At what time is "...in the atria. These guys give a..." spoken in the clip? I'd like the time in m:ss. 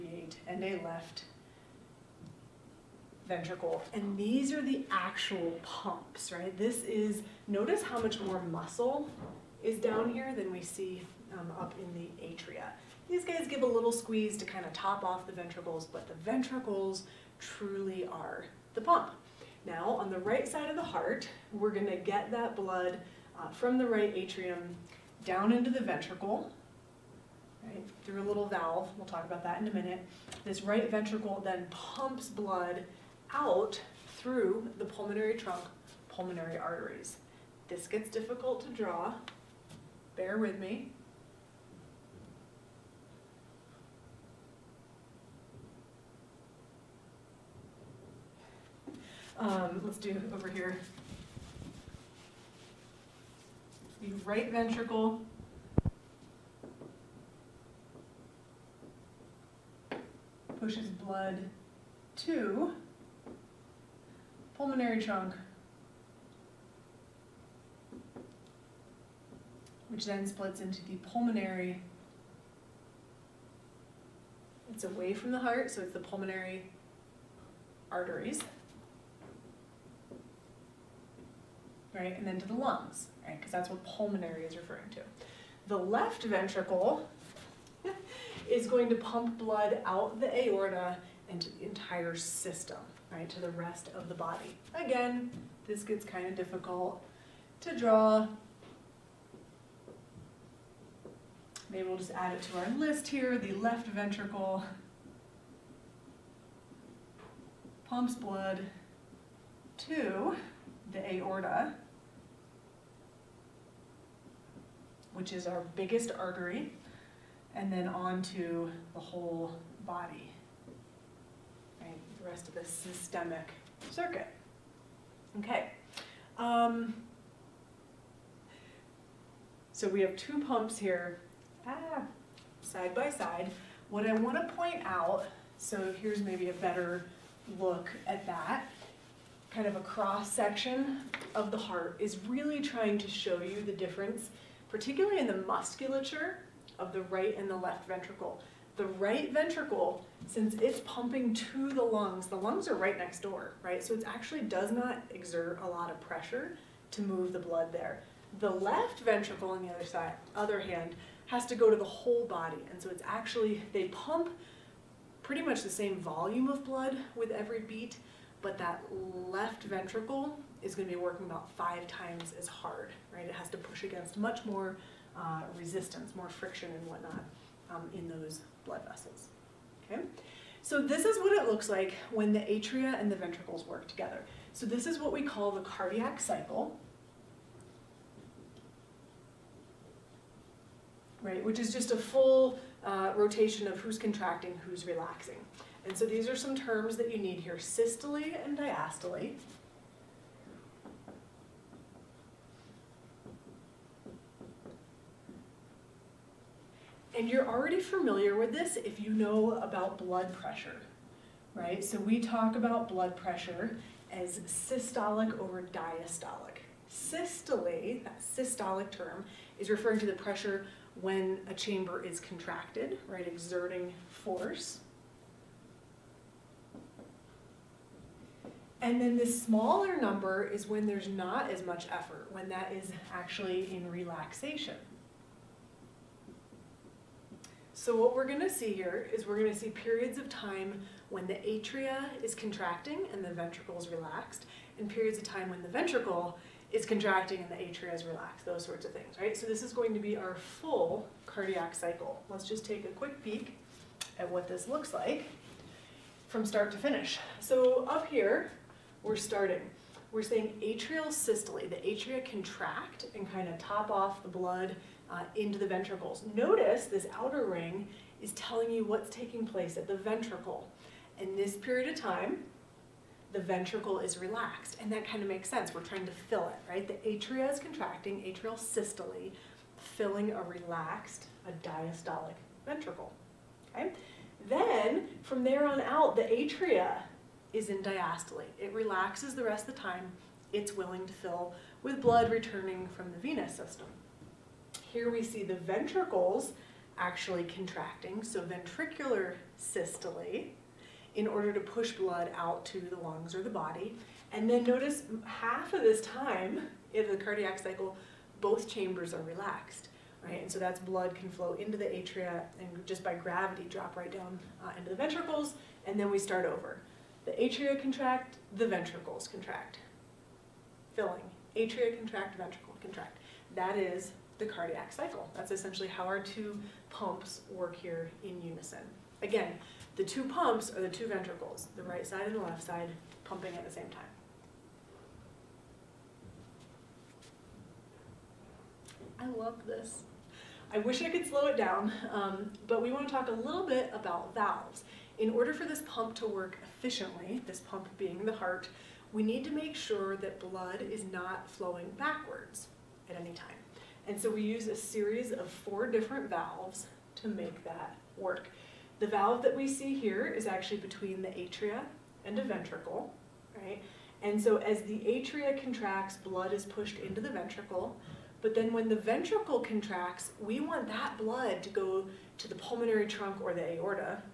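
0:11.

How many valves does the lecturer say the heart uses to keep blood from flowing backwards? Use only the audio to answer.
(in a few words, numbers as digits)
4.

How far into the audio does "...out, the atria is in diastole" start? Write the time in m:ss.
4:45.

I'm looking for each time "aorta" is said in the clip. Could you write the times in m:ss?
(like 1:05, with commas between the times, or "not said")
1:30, 1:51, 6:13.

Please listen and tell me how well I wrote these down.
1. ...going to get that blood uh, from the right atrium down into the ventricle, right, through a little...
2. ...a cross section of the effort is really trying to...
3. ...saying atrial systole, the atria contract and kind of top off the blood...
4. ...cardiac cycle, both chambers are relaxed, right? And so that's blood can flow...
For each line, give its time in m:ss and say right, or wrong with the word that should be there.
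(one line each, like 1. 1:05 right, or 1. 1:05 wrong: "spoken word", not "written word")
1. 0:21 right
2. 2:19 wrong: "heart", not "effort"
3. 4:20 right
4. 5:07 right.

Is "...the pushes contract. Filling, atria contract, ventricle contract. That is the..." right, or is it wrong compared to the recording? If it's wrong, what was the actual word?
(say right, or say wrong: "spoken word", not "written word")
wrong: "ventricles", not "pushes".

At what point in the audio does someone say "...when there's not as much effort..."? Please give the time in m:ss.
3:50.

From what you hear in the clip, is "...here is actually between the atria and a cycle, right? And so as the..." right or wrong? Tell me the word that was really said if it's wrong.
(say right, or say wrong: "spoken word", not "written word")
wrong: "ventricle", not "cycle".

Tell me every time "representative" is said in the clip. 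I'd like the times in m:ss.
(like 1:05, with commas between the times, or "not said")
not said.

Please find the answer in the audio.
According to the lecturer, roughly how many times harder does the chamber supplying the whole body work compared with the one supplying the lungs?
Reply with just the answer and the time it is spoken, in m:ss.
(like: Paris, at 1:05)
5 times, at 2:51.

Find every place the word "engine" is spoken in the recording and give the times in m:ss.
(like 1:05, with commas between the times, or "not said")
not said.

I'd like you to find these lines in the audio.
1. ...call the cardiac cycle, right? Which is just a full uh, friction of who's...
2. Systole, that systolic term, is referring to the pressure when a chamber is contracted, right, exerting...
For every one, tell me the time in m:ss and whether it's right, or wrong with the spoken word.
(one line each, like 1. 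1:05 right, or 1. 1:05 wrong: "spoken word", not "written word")
1. 3:05 wrong: "rotation", not "friction"
2. 3:36 right.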